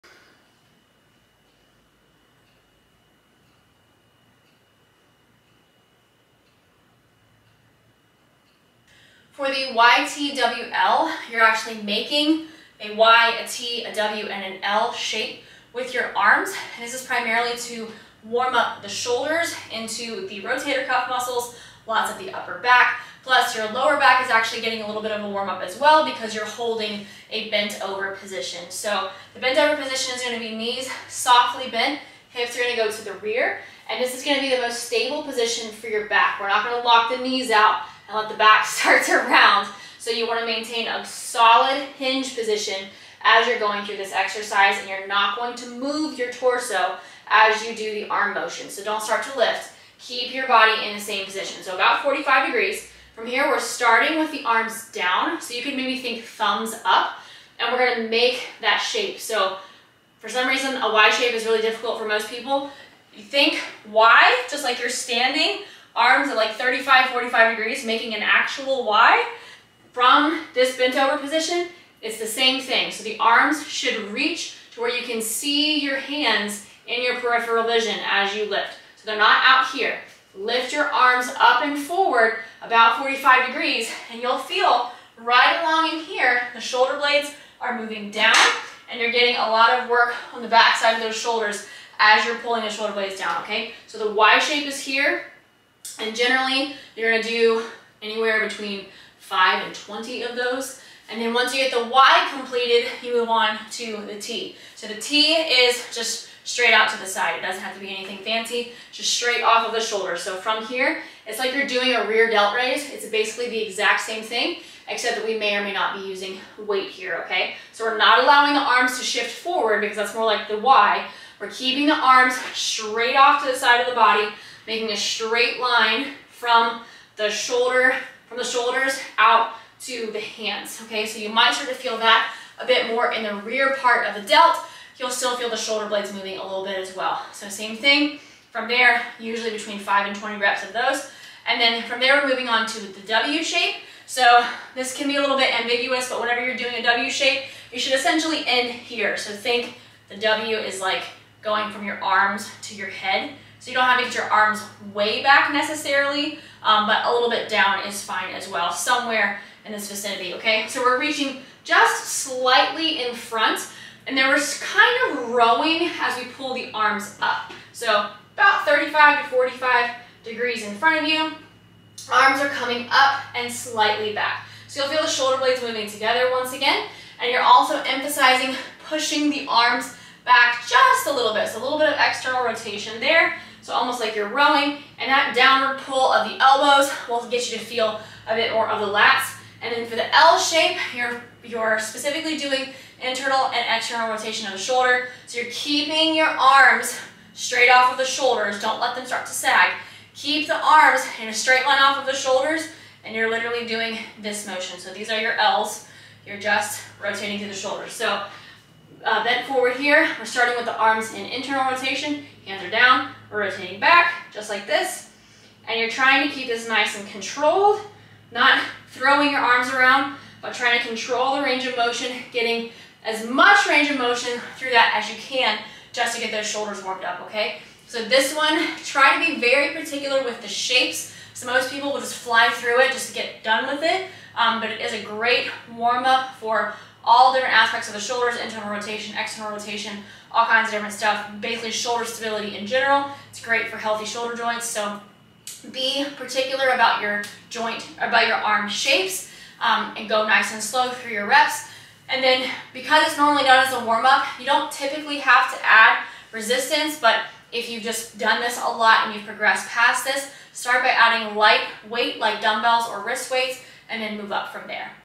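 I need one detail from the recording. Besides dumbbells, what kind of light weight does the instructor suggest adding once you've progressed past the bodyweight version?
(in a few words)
wrist weights.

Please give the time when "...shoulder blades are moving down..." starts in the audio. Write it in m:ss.
1:26.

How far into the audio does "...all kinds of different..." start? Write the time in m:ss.
4:00.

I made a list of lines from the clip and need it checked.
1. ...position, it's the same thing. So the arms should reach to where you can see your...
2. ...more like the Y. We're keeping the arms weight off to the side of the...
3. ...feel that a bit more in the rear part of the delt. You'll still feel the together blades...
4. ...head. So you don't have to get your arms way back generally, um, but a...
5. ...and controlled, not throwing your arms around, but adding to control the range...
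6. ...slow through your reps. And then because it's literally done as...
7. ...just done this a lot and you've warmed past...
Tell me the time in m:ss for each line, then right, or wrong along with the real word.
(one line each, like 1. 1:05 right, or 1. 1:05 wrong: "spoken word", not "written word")
1. 1:11 right
2. 2:00 wrong: "straight", not "weight"
3. 2:11 wrong: "shoulder", not "together"
4. 2:32 wrong: "necessarily", not "generally"
5. 3:36 wrong: "trying", not "adding"
6. 4:10 wrong: "normally", not "literally"
7. 4:17 wrong: "progressed", not "warmed".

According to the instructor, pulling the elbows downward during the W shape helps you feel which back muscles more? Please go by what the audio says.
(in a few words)
lats.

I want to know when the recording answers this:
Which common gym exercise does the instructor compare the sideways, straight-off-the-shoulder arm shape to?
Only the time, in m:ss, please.
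1:52.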